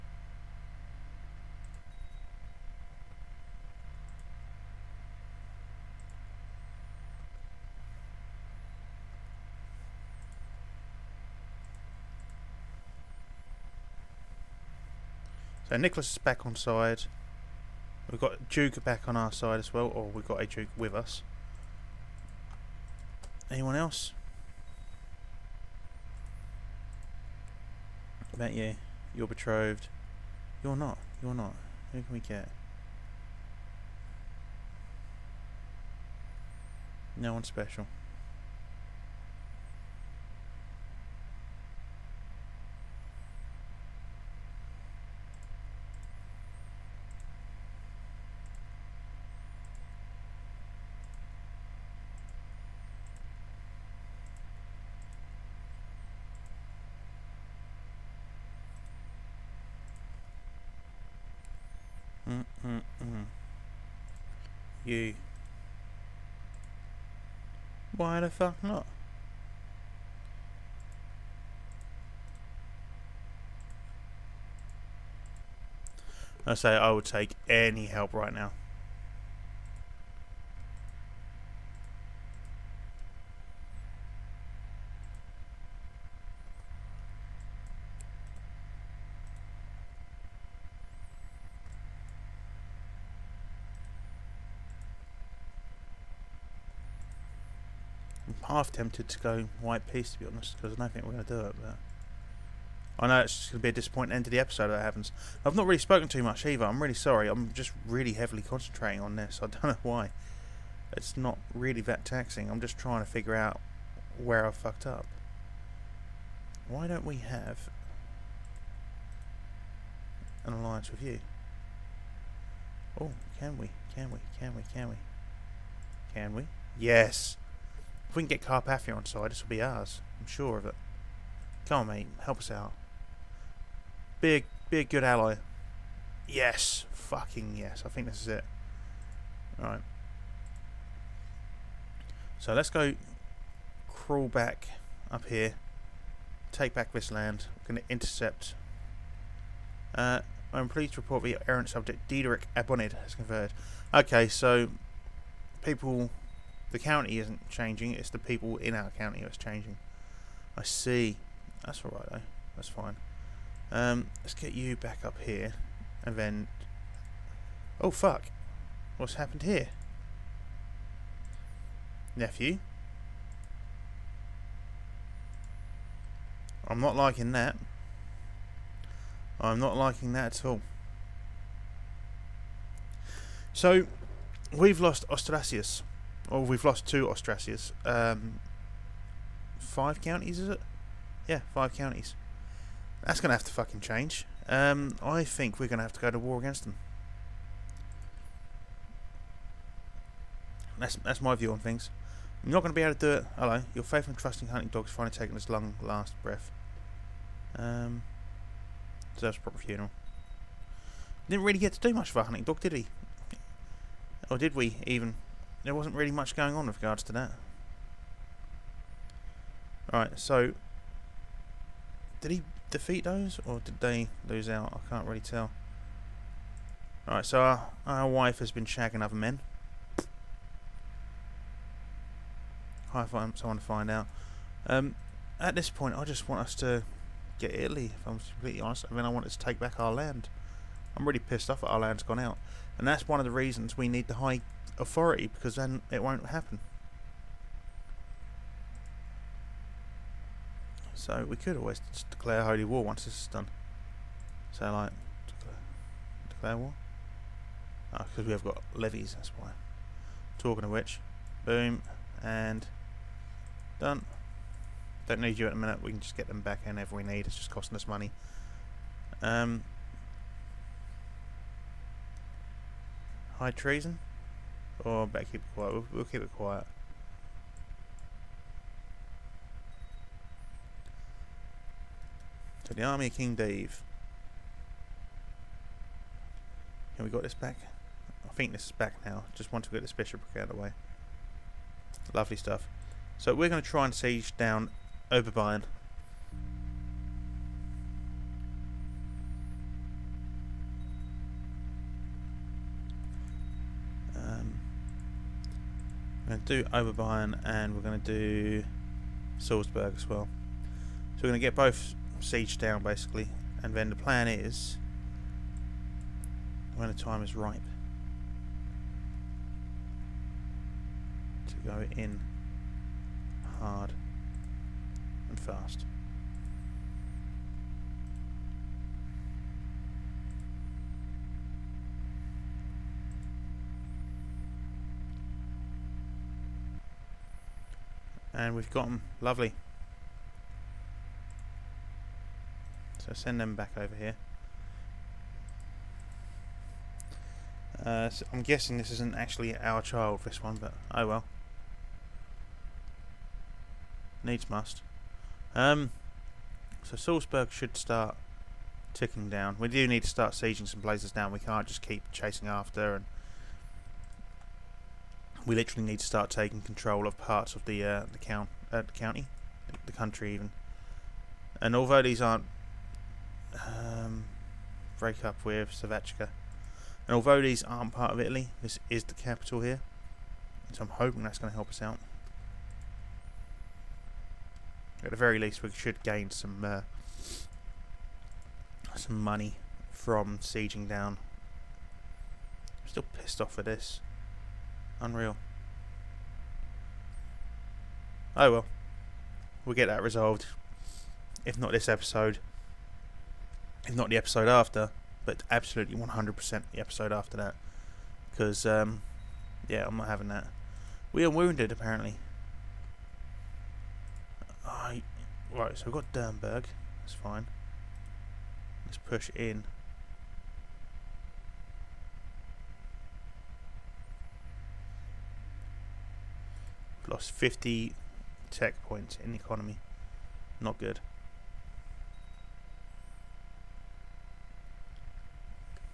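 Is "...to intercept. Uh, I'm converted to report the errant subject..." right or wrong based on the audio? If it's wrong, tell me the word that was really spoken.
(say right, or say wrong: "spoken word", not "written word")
wrong: "pleased", not "converted".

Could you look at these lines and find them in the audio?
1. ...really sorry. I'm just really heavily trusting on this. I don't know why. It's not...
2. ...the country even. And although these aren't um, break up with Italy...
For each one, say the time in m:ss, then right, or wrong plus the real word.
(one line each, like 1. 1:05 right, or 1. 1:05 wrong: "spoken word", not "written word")
1. 1:46 wrong: "concentrating", not "trusting"
2. 6:09 wrong: "Savechka", not "Italy".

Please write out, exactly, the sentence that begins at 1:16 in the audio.
I say I would take any help right now.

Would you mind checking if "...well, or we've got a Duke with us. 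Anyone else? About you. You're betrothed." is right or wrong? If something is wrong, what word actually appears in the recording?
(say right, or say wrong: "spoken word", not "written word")
right.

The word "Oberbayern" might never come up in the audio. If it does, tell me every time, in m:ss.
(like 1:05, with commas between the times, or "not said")
4:55, 5:06.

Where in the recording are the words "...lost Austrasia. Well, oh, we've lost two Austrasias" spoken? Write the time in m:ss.
3:04.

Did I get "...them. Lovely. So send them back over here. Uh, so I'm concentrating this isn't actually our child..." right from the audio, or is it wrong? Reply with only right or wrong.
wrong.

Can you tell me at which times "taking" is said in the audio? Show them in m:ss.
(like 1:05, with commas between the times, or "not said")
3:25, 6:06.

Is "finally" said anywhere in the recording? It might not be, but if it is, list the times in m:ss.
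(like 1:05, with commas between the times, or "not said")
3:24.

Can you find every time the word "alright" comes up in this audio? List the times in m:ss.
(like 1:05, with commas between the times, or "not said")
2:19, 2:41, 3:39, 3:47.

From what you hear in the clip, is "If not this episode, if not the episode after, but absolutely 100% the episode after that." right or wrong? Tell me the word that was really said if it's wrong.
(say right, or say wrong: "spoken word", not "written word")
right.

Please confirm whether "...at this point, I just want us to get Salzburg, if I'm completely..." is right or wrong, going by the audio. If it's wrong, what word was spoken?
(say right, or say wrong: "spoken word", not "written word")
wrong: "Italy", not "Salzburg".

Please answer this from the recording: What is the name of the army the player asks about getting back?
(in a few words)
Army of King Dave.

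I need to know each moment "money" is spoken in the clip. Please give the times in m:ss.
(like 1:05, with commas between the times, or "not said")
4:27, 6:29.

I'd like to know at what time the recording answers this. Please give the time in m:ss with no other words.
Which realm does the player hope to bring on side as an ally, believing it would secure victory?
2:08.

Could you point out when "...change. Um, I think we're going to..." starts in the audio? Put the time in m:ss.
3:13.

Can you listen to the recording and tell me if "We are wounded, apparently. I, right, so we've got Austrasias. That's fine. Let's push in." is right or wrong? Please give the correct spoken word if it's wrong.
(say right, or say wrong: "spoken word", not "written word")
wrong: "Dernberg", not "Austrasias".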